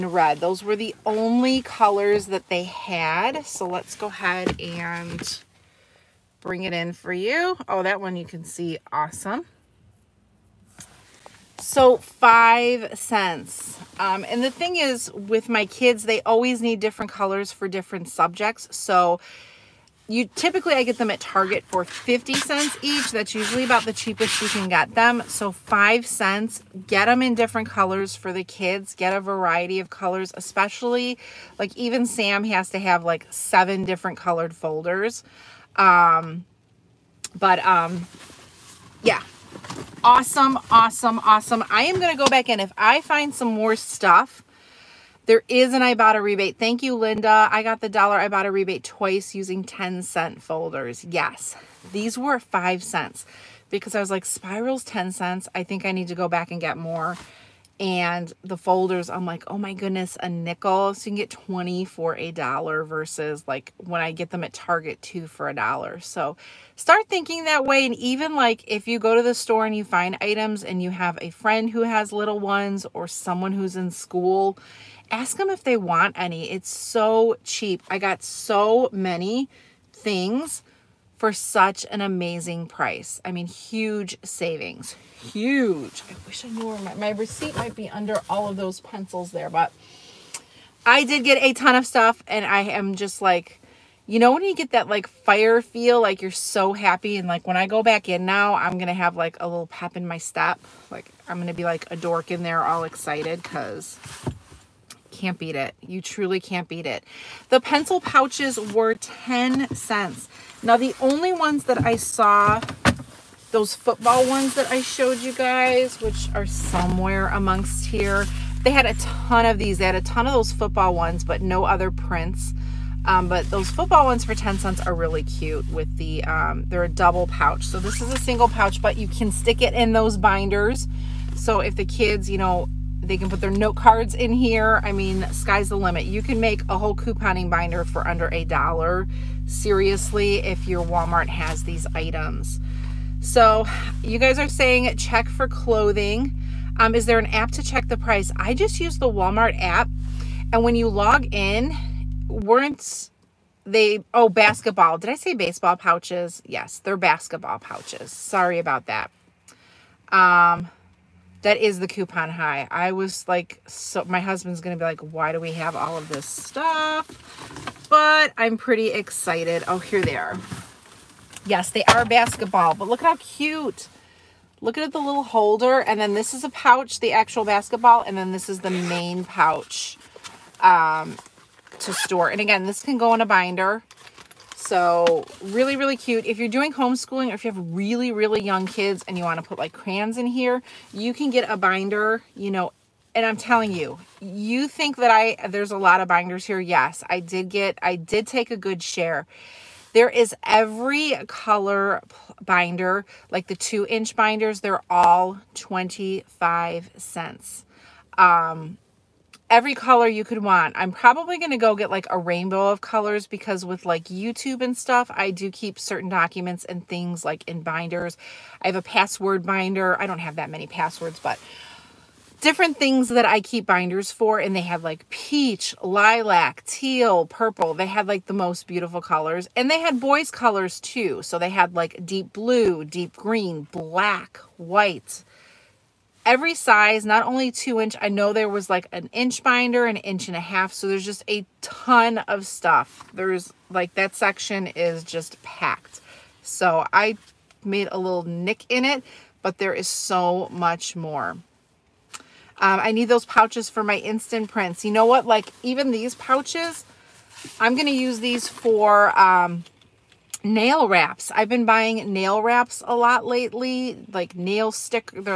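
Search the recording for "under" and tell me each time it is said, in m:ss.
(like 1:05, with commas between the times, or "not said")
1:27, 2:18.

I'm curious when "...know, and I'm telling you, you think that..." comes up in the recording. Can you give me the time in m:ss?
3:12.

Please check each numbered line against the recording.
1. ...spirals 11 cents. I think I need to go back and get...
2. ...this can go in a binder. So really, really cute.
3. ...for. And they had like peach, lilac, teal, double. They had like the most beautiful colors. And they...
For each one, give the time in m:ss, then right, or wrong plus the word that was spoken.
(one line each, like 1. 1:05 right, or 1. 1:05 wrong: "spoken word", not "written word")
1. 0:54 wrong: "10", not "11"
2. 3:02 right
3. 3:44 wrong: "purple", not "double".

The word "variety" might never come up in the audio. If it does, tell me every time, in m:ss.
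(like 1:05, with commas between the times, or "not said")
0:29.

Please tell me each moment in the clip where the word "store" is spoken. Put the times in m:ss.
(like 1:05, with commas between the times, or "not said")
1:09, 3:01.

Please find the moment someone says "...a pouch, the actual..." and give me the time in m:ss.
2:56.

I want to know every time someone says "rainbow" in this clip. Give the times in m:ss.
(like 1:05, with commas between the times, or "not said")
3:32.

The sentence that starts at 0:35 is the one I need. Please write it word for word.
Um, but um, yeah, awesome, awesome, awesome.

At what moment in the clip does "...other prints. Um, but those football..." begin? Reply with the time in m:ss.
2:01.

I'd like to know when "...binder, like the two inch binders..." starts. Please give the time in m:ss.
3:22.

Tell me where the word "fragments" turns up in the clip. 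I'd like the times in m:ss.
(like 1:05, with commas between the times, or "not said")
not said.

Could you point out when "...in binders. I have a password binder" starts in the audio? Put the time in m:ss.
3:37.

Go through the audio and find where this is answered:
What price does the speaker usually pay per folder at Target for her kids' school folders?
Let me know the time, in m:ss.
0:21.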